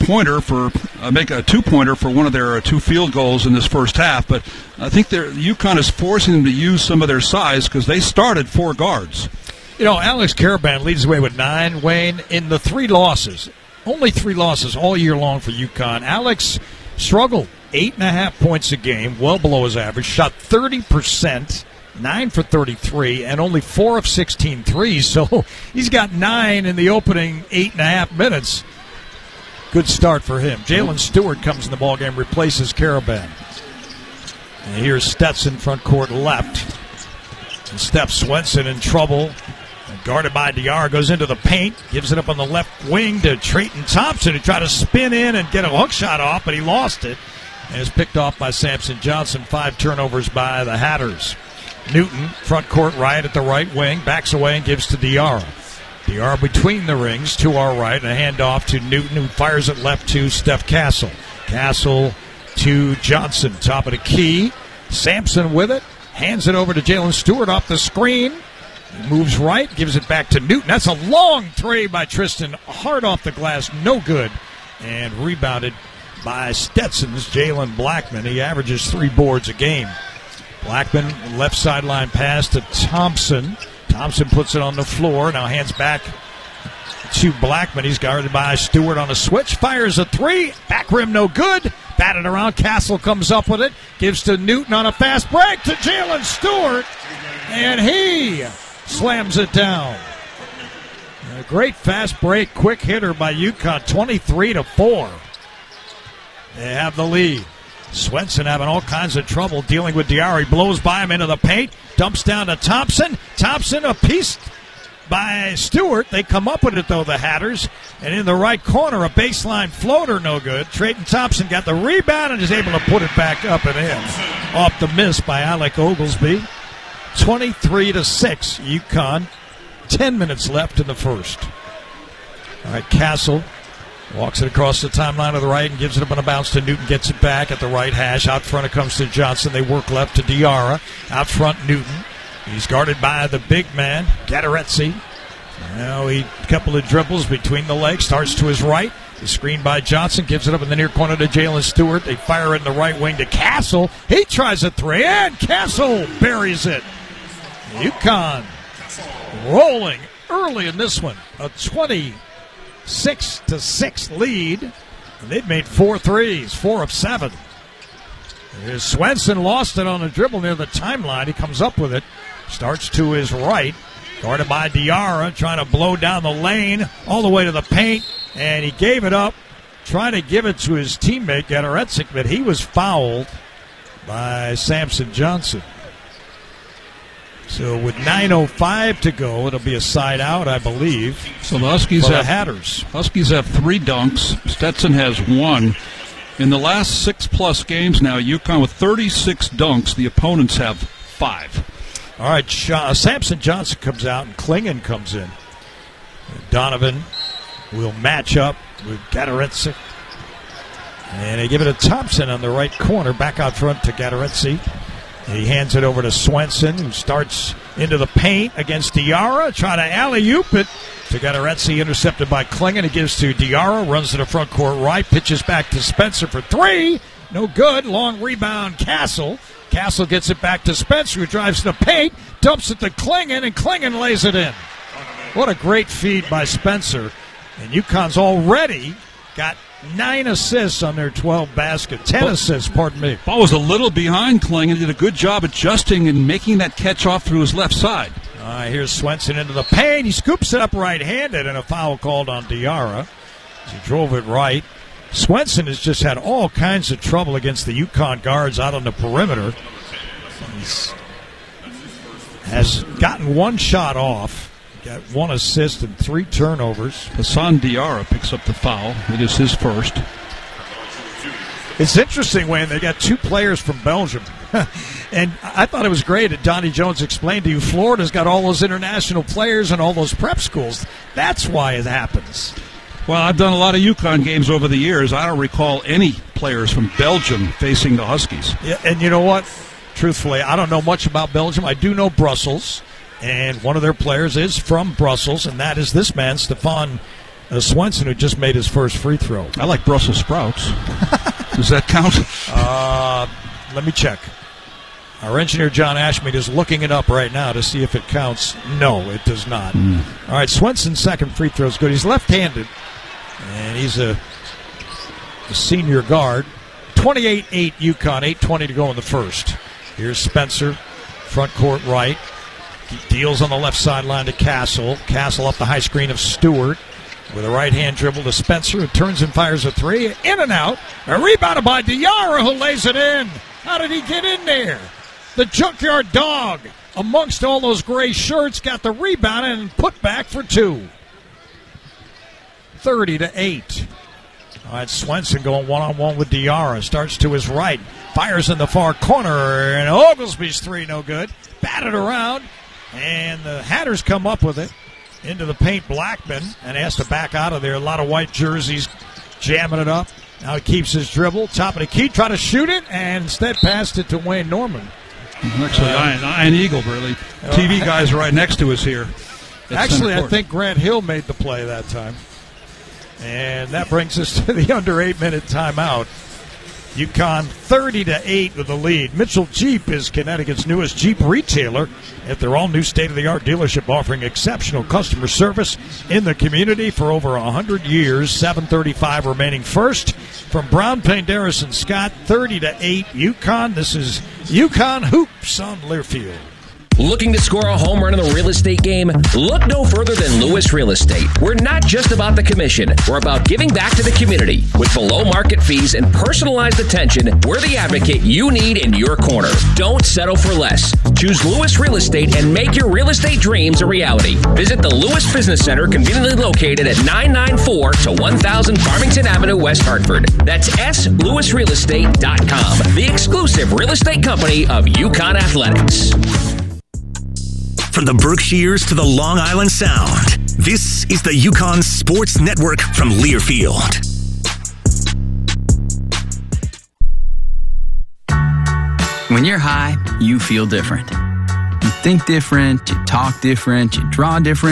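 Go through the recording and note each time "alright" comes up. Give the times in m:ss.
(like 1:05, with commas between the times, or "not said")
not said.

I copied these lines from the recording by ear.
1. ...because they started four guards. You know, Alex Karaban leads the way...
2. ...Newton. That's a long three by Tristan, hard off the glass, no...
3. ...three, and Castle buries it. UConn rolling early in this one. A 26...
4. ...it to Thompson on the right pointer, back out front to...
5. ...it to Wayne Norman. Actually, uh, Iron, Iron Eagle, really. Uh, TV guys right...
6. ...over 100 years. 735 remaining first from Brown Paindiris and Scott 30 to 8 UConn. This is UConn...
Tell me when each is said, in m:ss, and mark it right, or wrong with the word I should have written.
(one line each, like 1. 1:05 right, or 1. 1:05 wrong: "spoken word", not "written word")
1. 0:07 right
2. 1:10 right
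3. 2:34 right
4. 3:31 wrong: "corner", not "pointer"
5. 6:03 right
6. 6:27 right.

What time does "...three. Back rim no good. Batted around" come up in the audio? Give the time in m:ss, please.
1:30.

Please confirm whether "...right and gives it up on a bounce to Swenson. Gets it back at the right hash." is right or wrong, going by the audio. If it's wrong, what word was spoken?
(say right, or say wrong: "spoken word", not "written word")
wrong: "Newton", not "Swenson".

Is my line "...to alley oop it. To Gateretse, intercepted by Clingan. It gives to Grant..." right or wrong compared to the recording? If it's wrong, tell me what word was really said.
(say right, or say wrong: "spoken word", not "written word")
wrong: "Diarra", not "Grant".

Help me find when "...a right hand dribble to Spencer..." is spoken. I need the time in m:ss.
5:27.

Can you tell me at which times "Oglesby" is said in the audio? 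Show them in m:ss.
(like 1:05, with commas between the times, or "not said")
2:05, 5:49.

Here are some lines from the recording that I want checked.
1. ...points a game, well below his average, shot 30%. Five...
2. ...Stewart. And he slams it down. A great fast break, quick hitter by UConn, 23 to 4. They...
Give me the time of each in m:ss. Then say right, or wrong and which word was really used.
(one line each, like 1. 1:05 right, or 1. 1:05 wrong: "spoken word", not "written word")
1. 0:18 wrong: "Nine", not "Five"
2. 1:36 right.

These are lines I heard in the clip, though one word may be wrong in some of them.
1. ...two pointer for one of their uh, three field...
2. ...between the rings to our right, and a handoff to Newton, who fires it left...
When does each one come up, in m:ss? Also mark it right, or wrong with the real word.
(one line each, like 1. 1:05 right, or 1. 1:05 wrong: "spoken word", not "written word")
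1. 0:01 wrong: "two", not "three"
2. 0:56 right.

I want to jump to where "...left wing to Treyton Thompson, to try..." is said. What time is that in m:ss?
0:42.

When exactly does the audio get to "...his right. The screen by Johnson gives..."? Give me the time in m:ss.
2:28.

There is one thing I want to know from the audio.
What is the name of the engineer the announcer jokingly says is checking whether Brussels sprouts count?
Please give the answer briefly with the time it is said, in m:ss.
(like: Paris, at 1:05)
John Ashmead, at 5:05.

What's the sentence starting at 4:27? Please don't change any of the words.
Hassan Diarra picks up the foul.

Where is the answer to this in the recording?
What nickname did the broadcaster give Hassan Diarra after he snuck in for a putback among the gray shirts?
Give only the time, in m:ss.
5:35.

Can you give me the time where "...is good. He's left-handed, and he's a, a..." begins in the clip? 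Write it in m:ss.
5:11.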